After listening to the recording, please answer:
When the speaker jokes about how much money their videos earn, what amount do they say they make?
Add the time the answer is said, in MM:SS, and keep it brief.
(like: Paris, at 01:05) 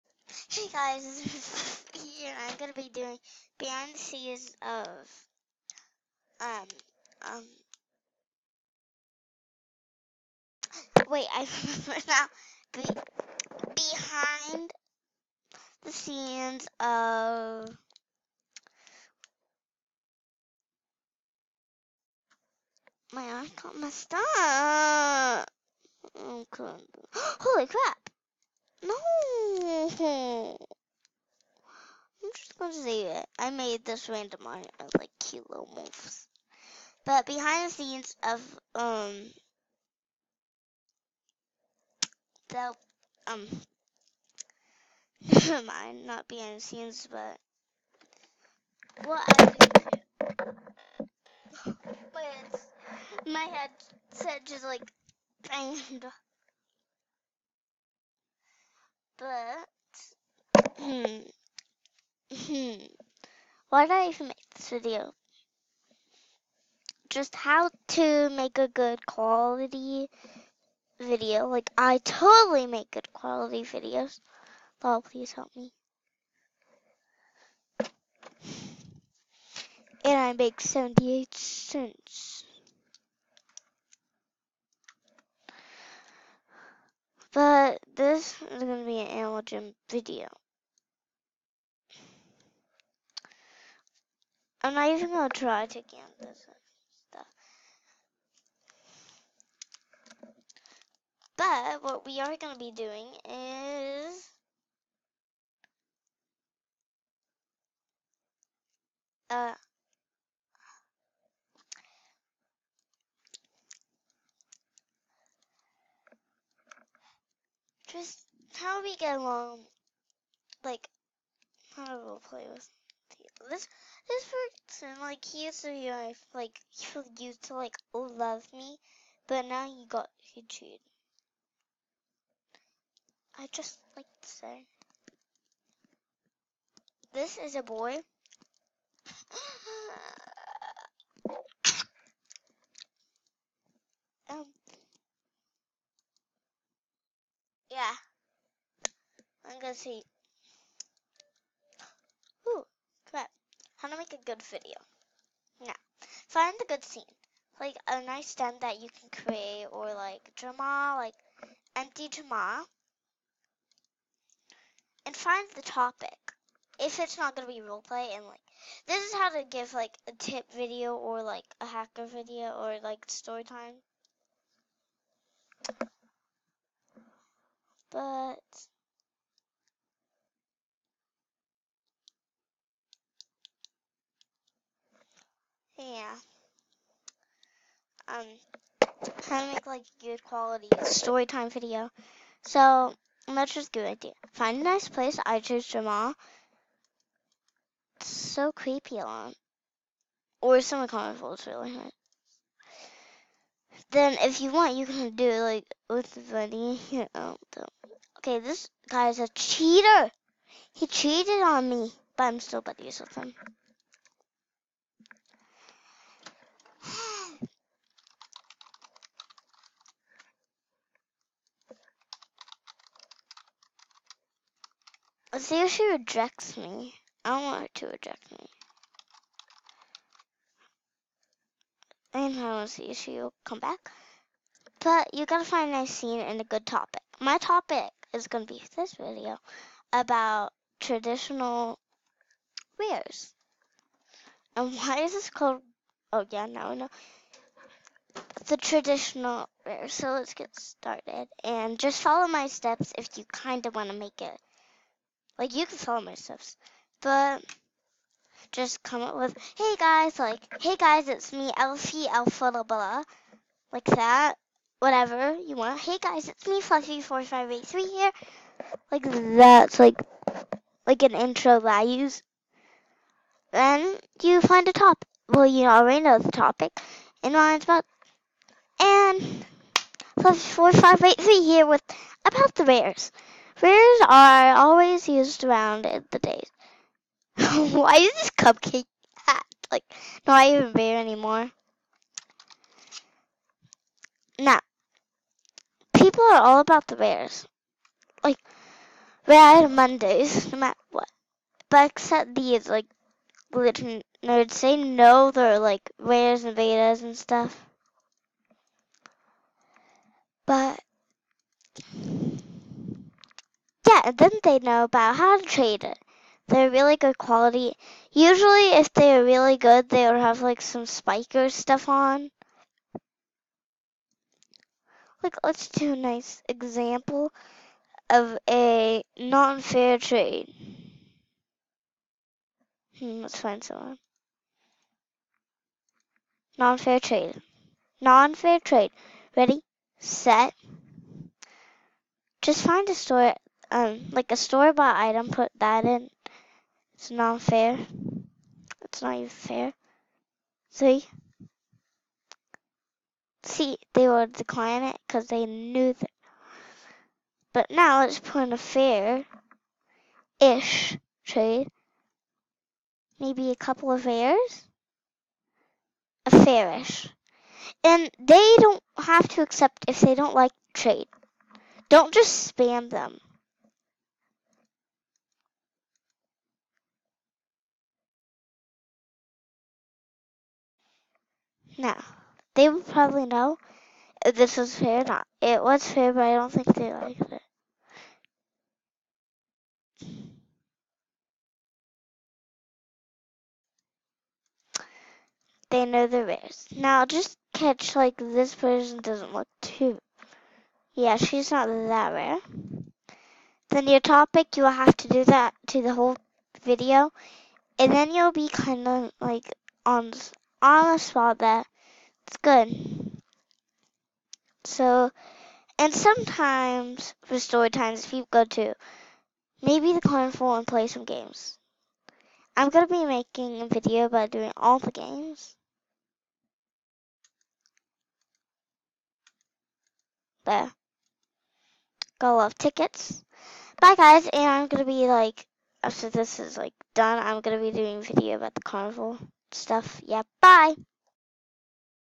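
78 cents, at 01:20.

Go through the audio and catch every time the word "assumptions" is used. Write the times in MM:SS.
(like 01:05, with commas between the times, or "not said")
not said.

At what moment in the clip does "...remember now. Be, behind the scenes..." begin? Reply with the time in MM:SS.
00:11.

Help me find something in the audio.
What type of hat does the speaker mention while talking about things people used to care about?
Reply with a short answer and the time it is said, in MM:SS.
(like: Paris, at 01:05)
cupcake hat, at 04:48.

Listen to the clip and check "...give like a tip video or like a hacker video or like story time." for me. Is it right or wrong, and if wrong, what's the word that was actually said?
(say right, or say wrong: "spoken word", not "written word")
right.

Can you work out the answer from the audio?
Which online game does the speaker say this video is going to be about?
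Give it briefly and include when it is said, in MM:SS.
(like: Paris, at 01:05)
Animal Jam, at 01:29.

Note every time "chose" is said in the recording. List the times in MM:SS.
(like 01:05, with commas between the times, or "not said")
03:15.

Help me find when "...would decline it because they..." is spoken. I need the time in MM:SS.
05:54.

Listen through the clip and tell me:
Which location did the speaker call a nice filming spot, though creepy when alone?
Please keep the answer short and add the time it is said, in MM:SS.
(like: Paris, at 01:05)
Jamal, at 03:15.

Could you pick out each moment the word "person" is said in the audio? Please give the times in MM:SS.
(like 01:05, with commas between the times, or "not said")
02:04, 06:38.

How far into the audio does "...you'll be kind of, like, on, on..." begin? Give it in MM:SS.
06:48.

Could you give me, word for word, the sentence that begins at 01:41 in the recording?
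But what we are going to be doing is...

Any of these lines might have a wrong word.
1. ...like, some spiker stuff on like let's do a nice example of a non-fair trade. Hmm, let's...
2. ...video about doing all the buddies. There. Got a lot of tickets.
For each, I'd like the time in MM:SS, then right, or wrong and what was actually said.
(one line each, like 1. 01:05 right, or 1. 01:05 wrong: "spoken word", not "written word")
1. 05:20 right
2. 07:03 wrong: "games", not "buddies".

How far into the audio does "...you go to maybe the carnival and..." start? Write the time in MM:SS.
06:58.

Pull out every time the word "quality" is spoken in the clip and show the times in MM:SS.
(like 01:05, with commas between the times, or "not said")
01:09, 01:13, 03:10, 05:17.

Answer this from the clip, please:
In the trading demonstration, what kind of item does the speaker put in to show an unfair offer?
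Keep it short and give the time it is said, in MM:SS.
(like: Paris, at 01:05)
store-bought item, at 05:44.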